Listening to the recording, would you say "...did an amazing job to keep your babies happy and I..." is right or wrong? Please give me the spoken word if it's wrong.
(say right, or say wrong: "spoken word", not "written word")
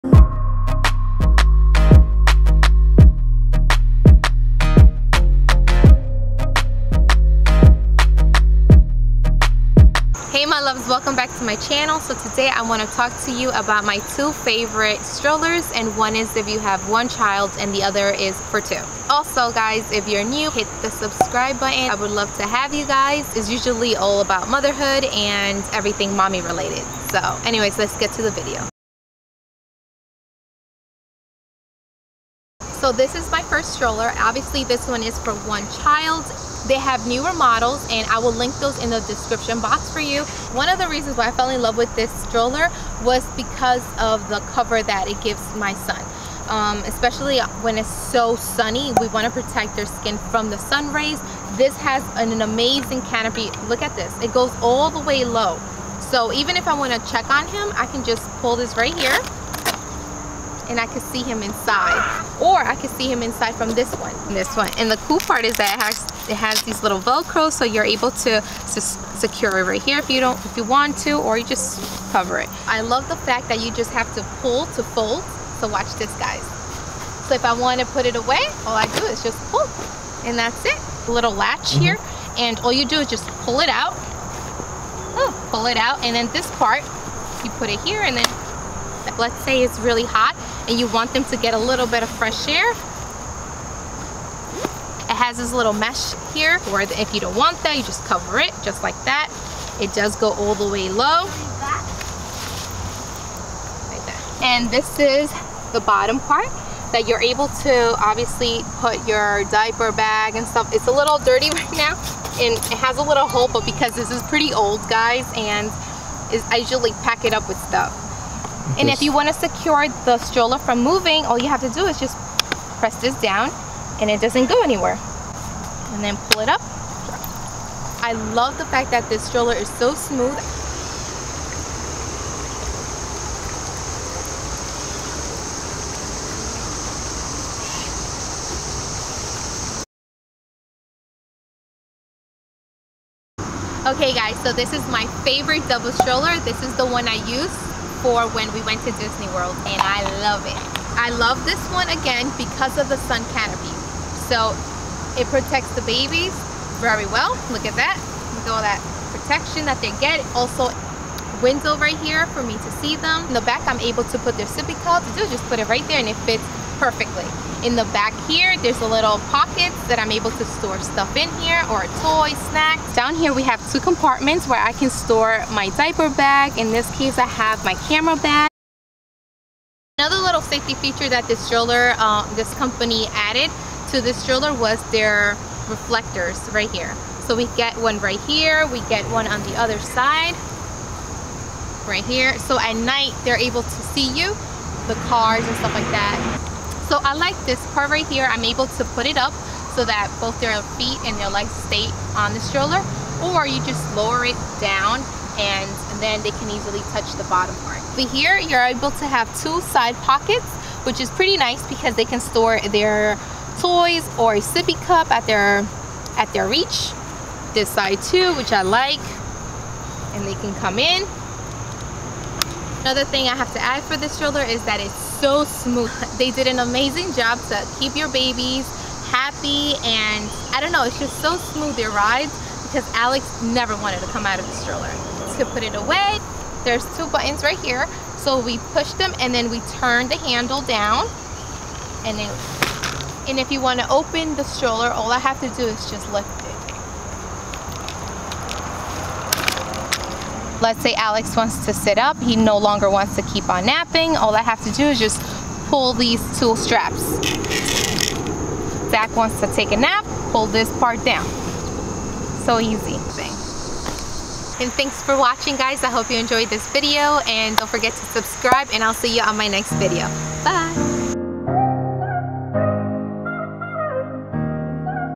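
right.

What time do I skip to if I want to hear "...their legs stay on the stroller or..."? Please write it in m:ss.
3:21.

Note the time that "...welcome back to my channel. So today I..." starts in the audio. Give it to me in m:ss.
0:10.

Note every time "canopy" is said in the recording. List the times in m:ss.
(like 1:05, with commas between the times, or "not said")
0:53, 2:33.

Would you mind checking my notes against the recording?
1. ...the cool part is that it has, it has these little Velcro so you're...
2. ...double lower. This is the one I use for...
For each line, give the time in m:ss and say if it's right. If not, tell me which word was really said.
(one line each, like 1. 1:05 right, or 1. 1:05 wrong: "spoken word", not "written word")
1. 1:04 right
2. 2:25 wrong: "stroller", not "lower".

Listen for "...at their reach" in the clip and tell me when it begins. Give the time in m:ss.
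3:36.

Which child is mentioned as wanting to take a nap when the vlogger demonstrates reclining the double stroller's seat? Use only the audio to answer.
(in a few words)
Zach.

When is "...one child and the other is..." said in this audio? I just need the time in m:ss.
0:16.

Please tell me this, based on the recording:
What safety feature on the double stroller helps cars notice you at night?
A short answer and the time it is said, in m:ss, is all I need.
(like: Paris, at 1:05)
reflectors, at 3:05.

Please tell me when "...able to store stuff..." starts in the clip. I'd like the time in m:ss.
2:50.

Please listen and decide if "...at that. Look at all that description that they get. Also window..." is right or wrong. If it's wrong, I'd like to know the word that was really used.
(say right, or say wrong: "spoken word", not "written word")
wrong: "protection", not "description".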